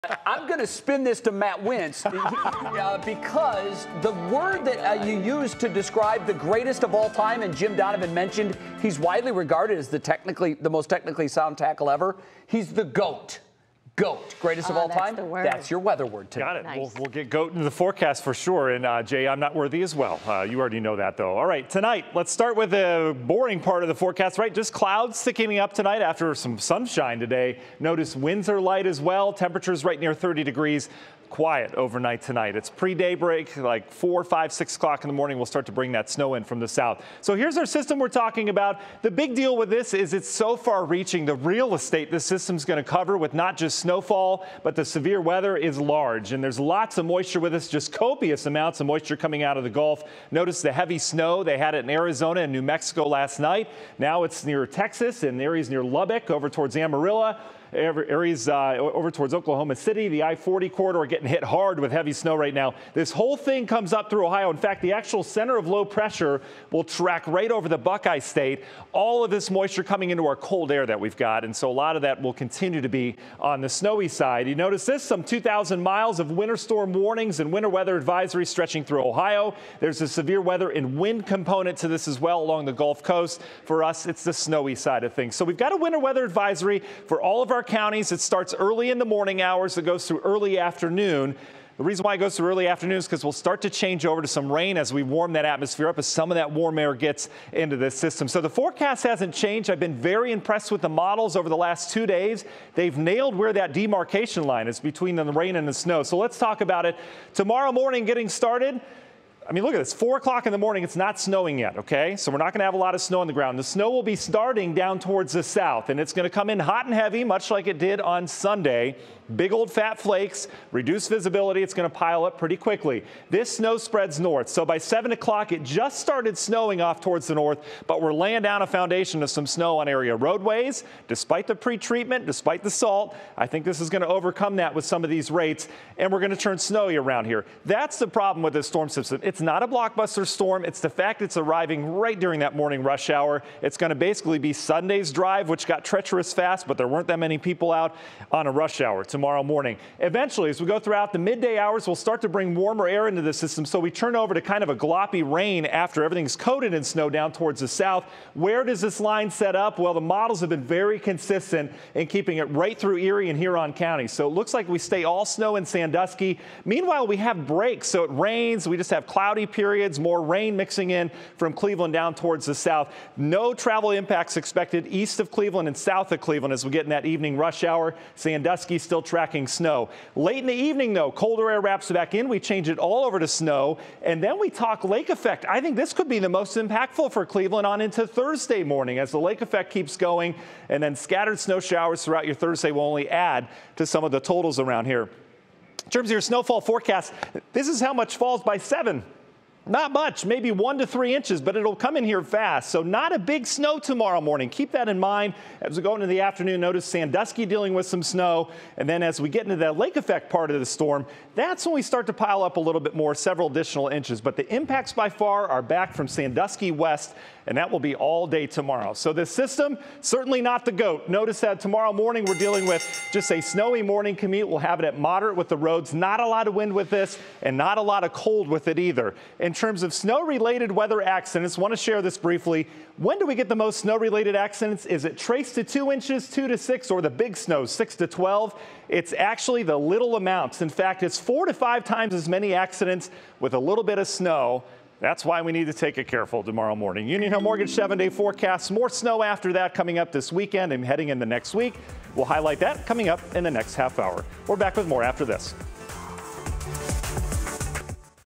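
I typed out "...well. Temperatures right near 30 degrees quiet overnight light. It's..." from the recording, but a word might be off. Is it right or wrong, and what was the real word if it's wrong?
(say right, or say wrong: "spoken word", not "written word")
wrong: "tonight", not "light".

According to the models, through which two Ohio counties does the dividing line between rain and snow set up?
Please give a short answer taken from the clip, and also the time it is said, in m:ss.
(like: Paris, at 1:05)
Erie and Huron, at 2:42.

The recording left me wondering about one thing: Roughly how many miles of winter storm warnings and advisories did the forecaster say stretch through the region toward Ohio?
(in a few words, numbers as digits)
2,000.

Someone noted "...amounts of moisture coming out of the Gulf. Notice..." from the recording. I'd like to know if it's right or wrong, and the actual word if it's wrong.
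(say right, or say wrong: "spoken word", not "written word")
right.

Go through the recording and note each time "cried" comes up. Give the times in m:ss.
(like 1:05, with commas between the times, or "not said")
not said.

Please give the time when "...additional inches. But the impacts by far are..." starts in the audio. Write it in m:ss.
3:33.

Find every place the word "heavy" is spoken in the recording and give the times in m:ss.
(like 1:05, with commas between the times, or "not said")
0:50, 1:01, 1:56.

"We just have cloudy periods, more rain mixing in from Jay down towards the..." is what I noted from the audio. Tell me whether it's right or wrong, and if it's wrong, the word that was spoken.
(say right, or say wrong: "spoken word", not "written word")
wrong: "Cleveland", not "Jay".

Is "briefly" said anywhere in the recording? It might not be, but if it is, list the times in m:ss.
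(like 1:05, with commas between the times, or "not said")
3:52.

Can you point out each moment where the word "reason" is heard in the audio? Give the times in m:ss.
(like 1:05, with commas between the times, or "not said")
1:31.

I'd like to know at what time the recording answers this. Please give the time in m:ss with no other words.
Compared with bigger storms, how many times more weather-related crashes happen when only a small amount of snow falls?
4:01.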